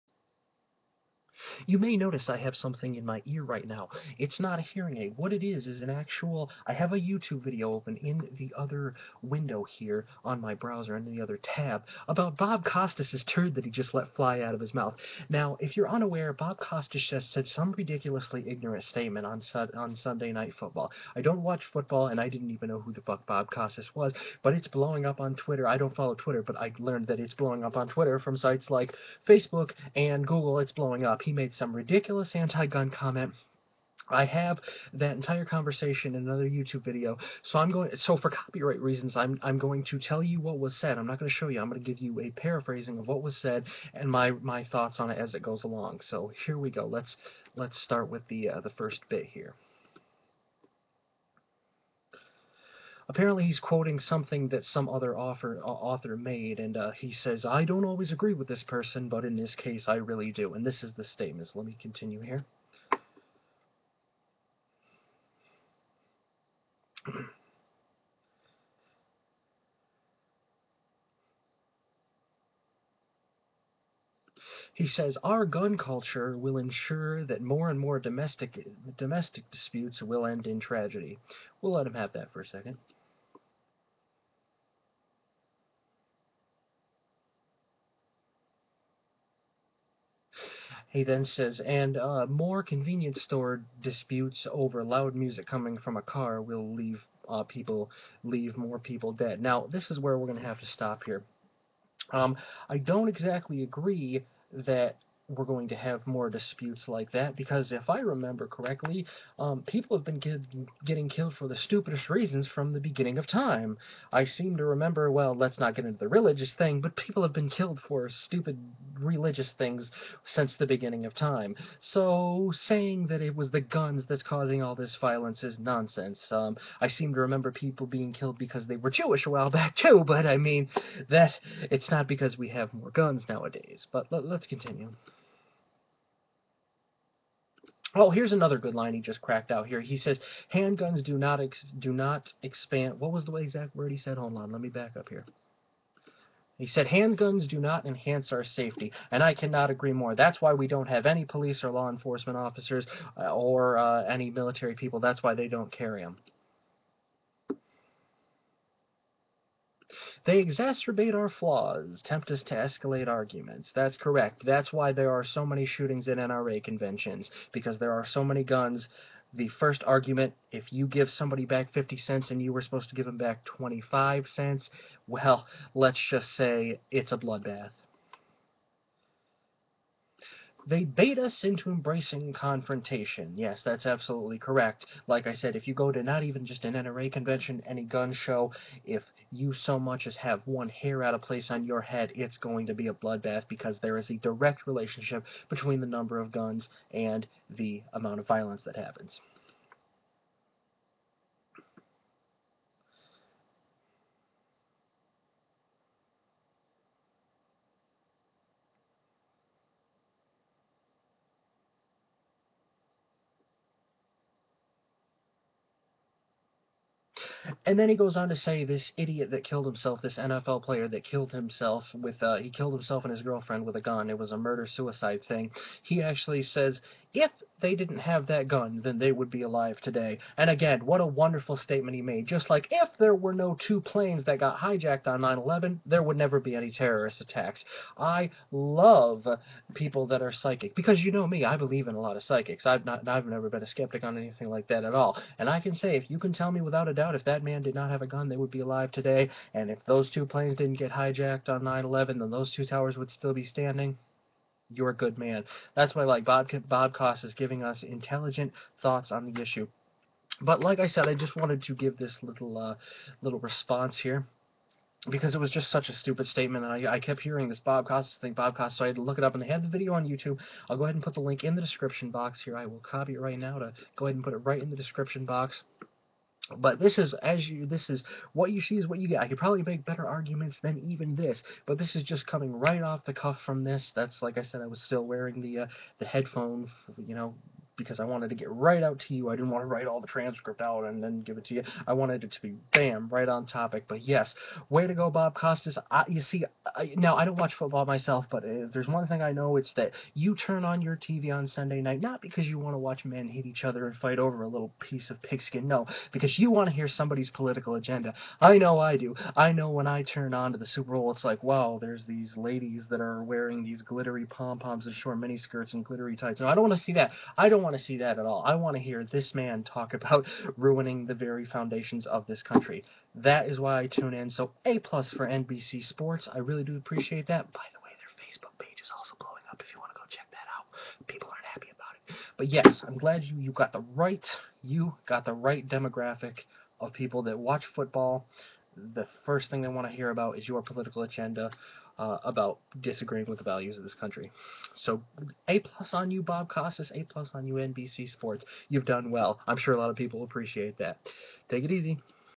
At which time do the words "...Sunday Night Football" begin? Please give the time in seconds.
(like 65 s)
19 s.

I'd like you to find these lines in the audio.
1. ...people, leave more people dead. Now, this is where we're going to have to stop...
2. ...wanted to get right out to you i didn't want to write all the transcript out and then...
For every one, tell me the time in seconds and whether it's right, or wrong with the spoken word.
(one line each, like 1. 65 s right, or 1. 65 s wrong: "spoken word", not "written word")
1. 97 s right
2. 288 s right.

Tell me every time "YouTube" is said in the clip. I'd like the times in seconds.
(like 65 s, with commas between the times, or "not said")
6 s, 36 s, 270 s.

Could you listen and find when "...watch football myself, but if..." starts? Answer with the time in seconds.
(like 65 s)
297 s.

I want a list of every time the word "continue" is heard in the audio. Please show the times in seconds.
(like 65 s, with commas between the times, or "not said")
61 s, 134 s.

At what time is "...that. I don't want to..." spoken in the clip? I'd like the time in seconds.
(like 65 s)
316 s.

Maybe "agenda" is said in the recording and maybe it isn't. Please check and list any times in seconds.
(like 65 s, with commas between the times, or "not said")
307 s, 341 s.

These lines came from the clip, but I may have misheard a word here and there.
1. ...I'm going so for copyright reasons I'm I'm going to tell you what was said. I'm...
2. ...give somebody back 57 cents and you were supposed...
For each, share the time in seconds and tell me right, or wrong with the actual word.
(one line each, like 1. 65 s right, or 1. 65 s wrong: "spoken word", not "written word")
1. 37 s right
2. 170 s wrong: "50", not "57".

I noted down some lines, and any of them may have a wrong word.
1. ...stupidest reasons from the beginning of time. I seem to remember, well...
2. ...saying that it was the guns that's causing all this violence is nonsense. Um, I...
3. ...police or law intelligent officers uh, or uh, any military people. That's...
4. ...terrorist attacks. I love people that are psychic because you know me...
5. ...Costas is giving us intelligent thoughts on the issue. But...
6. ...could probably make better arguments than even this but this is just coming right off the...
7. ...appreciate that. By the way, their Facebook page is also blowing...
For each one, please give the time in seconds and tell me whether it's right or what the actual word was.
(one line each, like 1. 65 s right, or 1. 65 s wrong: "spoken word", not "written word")
1. 111 s right
2. 122 s right
3. 151 s wrong: "enforcement", not "intelligent"
4. 236 s right
5. 256 s right
6. 279 s right
7. 326 s right.